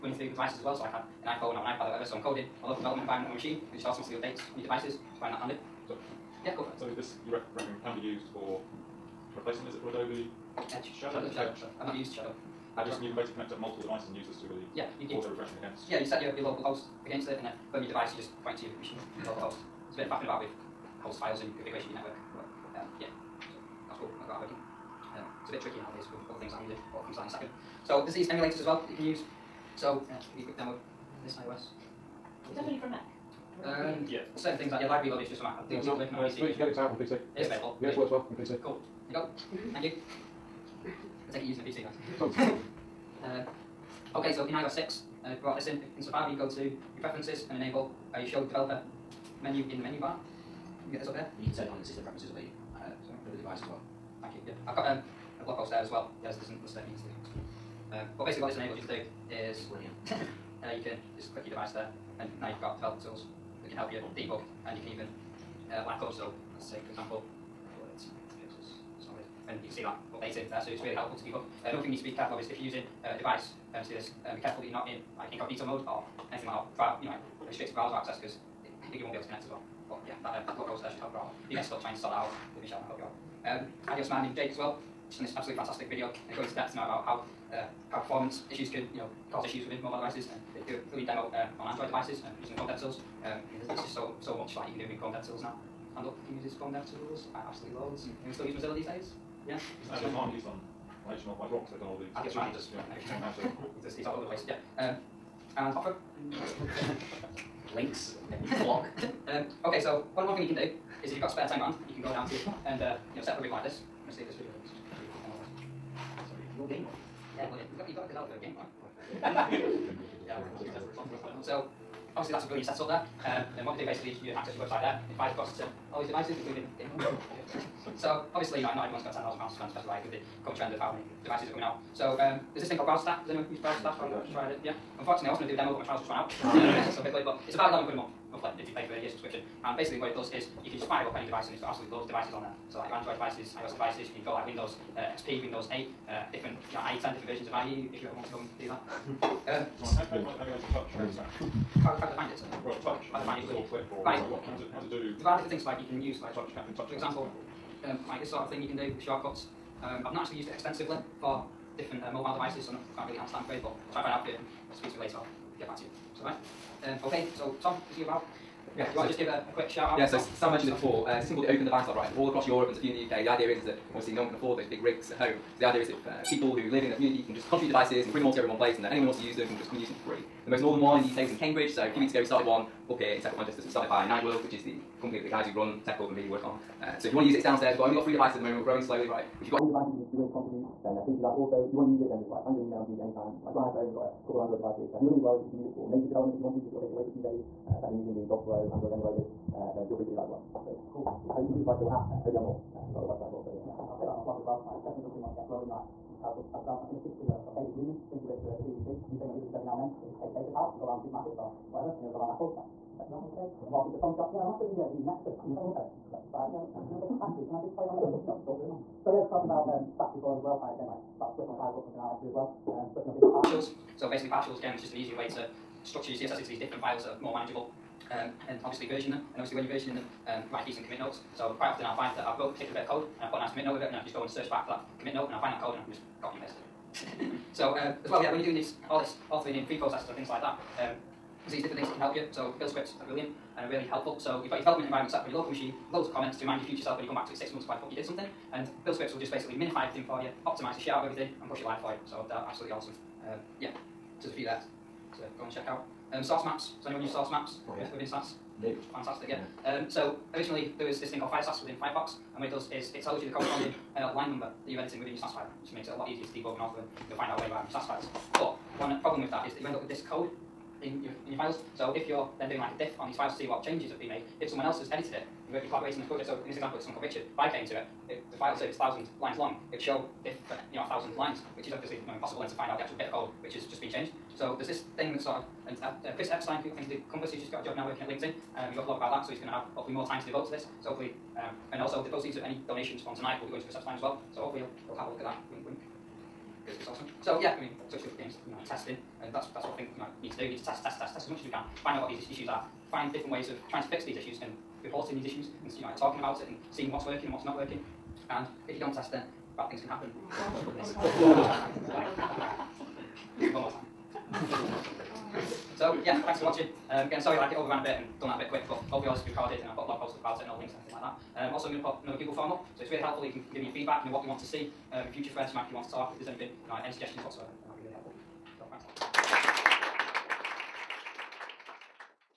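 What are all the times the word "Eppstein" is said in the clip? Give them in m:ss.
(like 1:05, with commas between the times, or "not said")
4:46, 4:53.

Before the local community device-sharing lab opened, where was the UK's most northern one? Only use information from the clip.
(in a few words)
Cambridge.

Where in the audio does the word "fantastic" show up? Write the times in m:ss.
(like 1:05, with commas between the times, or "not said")
1:25, 4:18.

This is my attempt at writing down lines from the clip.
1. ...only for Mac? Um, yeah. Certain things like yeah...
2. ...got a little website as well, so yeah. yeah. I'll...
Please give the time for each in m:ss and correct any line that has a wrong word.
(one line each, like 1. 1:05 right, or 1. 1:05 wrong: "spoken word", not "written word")
1. 0:32 right
2. 3:22 right.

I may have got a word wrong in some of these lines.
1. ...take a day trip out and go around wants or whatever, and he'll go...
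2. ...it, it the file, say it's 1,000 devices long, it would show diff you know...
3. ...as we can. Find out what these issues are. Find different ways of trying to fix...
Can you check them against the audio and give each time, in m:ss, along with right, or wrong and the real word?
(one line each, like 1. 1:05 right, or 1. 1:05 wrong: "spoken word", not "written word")
1. 3:30 wrong: "supermarkets", not "wants"
2. 4:37 wrong: "lines", not "devices"
3. 5:01 right.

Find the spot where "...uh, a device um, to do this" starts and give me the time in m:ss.
1:13.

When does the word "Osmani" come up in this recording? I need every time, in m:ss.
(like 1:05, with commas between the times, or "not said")
1:23, 1:42.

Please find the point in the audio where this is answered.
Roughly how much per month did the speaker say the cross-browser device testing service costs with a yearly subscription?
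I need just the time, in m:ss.
2:17.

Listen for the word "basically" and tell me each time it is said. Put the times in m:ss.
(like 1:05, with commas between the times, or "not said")
0:13, 0:58, 2:03, 2:19, 3:44, 4:09.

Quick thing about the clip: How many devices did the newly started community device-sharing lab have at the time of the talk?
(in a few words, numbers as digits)
3.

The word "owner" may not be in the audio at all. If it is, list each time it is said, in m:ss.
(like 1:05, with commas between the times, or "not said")
not said.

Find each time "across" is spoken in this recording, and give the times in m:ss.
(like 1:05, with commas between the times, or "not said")
2:05, 2:52.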